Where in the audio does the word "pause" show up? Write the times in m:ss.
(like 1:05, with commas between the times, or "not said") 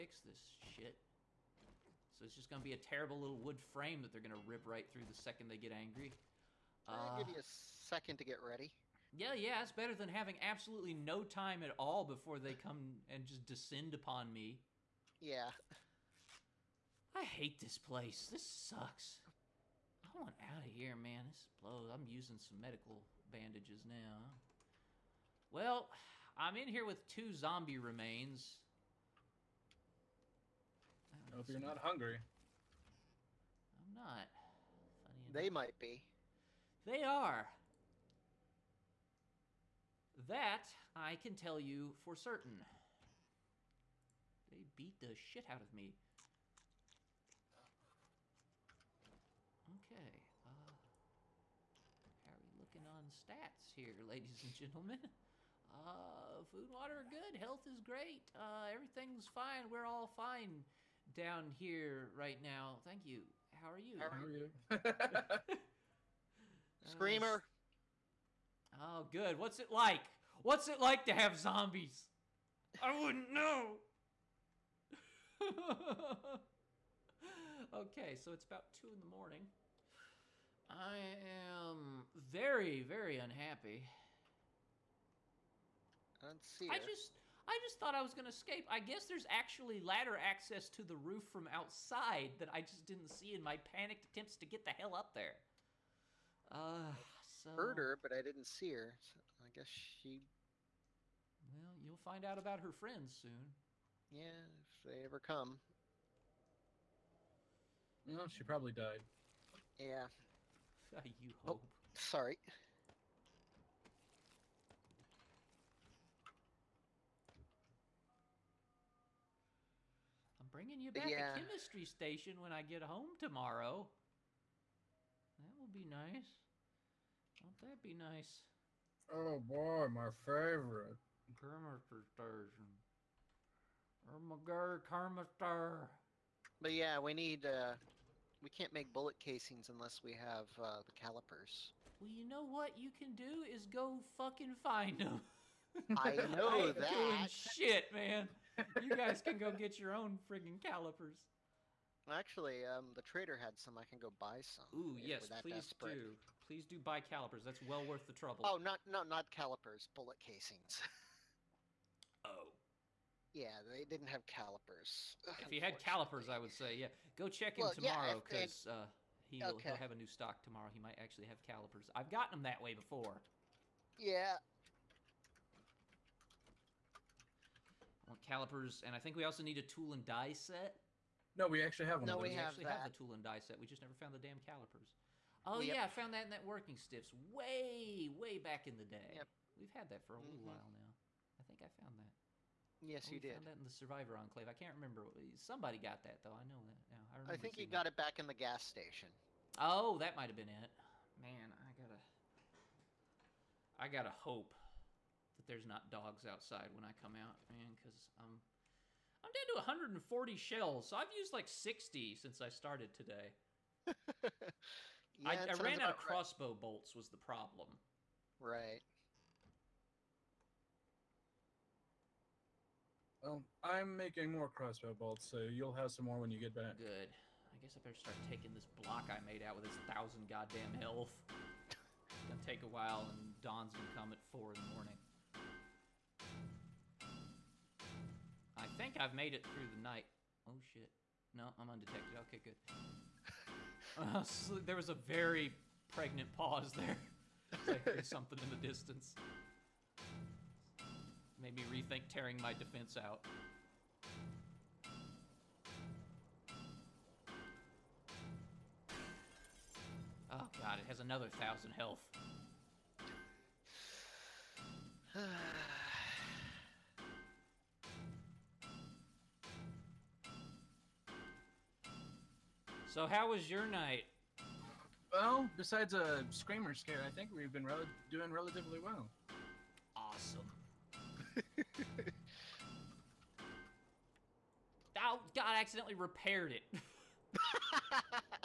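4:06.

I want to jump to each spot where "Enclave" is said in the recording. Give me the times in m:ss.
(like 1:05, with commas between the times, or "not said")
3:14.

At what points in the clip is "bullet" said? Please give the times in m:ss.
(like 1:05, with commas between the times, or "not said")
2:18, 2:39.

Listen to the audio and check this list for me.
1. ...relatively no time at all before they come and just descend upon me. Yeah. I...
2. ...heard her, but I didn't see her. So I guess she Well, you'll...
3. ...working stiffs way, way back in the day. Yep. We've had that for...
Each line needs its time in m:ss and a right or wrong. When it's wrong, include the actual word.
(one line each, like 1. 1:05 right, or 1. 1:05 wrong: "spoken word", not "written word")
1. 0:10 wrong: "absolutely", not "relatively"
2. 1:37 right
3. 3:06 right.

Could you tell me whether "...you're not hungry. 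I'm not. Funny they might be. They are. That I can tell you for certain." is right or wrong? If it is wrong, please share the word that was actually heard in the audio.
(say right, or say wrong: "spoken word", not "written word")
right.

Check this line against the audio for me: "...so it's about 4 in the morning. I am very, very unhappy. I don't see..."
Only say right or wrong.
wrong.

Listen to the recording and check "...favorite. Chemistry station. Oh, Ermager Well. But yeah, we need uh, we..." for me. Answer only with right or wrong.
wrong.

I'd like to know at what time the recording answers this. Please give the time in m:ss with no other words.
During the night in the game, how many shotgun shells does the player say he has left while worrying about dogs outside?
3:29.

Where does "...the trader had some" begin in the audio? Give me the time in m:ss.
2:32.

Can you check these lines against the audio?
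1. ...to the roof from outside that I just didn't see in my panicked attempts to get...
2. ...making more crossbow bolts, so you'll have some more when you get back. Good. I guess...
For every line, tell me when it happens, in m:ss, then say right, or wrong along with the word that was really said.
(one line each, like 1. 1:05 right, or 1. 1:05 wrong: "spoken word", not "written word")
1. 1:30 right
2. 3:43 right.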